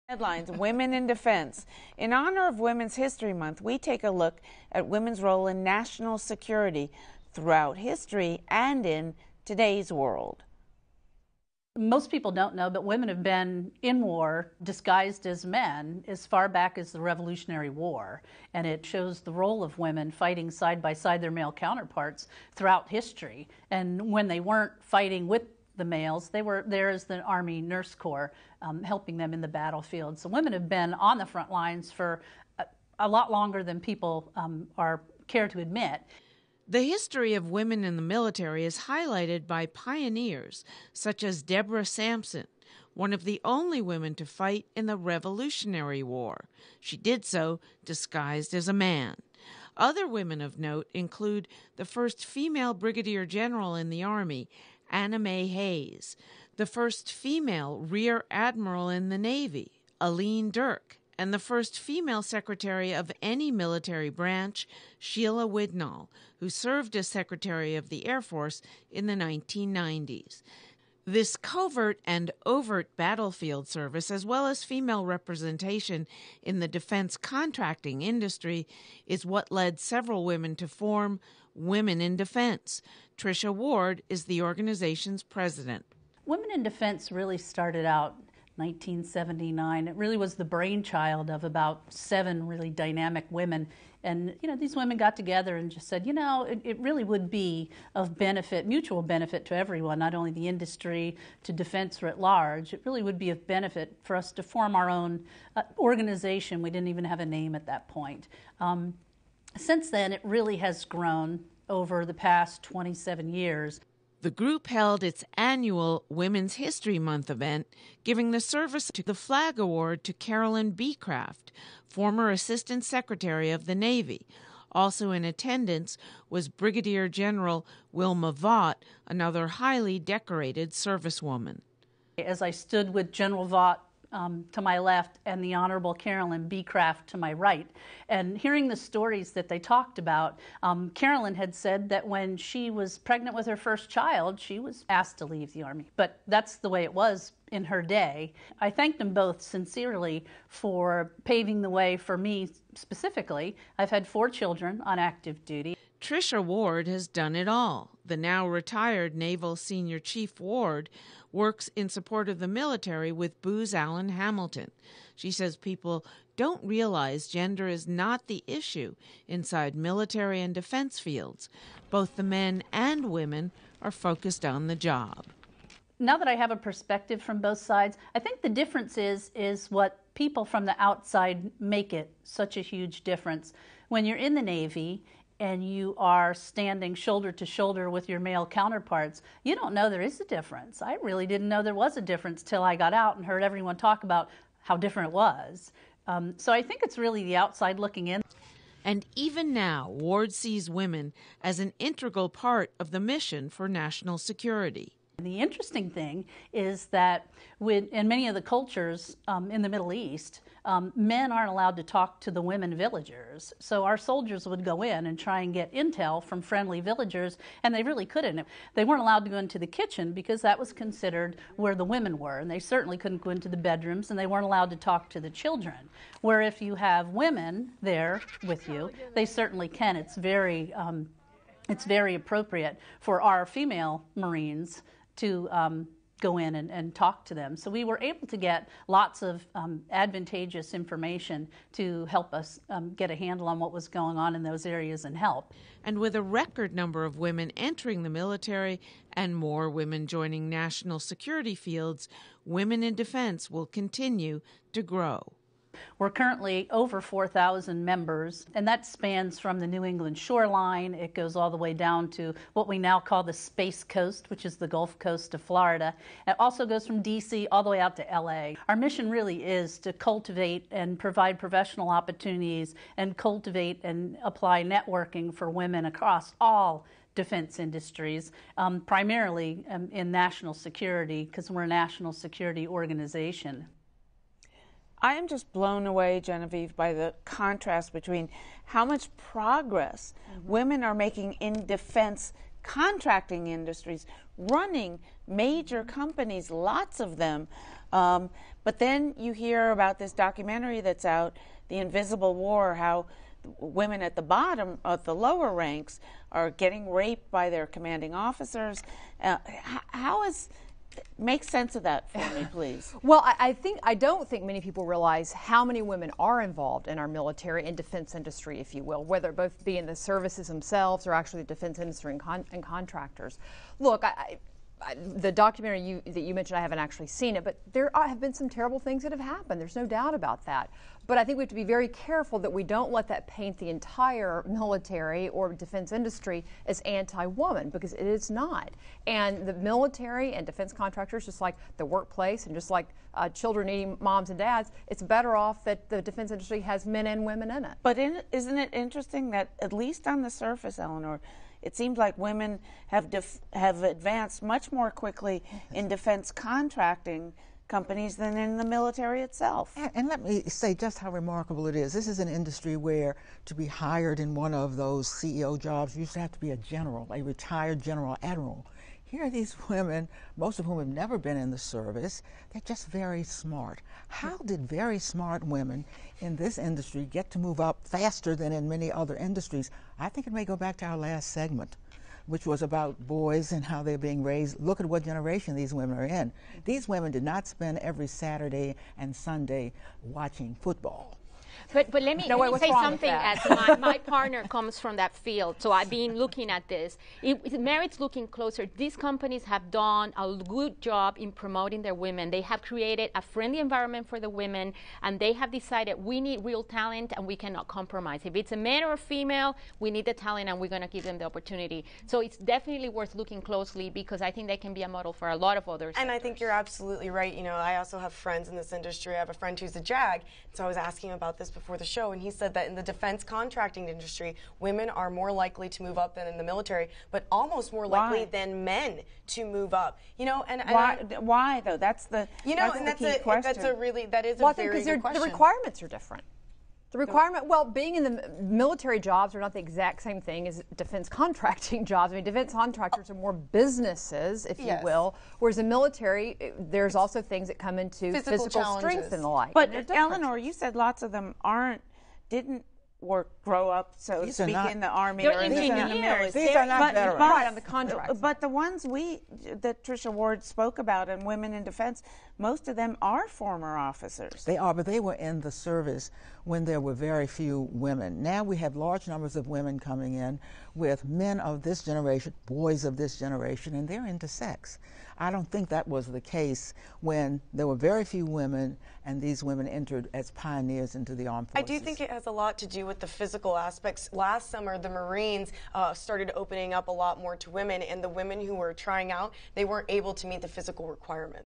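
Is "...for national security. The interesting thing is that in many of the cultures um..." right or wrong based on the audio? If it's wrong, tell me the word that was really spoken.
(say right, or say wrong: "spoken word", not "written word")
right.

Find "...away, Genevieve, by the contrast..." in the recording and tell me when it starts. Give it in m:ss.
4:45.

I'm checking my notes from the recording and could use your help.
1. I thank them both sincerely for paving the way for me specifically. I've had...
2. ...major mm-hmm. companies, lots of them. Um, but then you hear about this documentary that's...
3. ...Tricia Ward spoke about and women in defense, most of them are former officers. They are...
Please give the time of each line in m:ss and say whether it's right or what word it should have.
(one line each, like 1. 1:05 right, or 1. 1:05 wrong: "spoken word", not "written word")
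1. 2:28 right
2. 4:55 right
3. 7:39 right.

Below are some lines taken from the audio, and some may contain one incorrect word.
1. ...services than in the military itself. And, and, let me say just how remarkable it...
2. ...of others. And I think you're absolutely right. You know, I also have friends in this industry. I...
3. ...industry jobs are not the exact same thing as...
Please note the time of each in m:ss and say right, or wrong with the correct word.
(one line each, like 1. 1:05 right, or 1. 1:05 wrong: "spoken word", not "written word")
1. 5:57 wrong: "companies", not "services"
2. 6:55 right
3. 7:18 wrong: "military", not "industry".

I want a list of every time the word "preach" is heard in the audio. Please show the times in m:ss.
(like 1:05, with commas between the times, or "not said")
not said.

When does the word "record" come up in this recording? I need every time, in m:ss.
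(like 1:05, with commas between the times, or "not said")
4:06.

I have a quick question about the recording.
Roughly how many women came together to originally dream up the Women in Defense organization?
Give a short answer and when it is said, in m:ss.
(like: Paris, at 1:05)
7, at 1:31.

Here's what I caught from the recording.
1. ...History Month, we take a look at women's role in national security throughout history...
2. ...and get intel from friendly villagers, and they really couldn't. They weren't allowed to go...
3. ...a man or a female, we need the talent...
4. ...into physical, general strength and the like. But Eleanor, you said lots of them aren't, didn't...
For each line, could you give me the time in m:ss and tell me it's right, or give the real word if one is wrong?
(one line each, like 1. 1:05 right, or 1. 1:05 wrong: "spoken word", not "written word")
1. 0:02 right
2. 3:35 right
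3. 6:48 right
4. 7:27 wrong: "physical", not "general".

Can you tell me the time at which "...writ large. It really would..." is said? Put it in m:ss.
1:42.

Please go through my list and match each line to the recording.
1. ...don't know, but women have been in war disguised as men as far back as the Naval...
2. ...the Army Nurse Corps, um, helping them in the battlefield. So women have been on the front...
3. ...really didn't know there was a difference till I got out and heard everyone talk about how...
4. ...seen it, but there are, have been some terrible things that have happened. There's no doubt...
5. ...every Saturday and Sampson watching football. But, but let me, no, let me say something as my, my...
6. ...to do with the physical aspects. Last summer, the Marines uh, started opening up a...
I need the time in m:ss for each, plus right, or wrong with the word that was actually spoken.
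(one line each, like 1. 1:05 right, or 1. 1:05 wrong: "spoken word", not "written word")
1. 0:12 wrong: "Revolutionary", not "Naval"
2. 0:27 right
3. 3:11 right
4. 5:27 right
5. 6:27 wrong: "Sunday", not "Sampson"
6. 8:02 right.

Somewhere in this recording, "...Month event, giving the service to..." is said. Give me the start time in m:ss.
1:56.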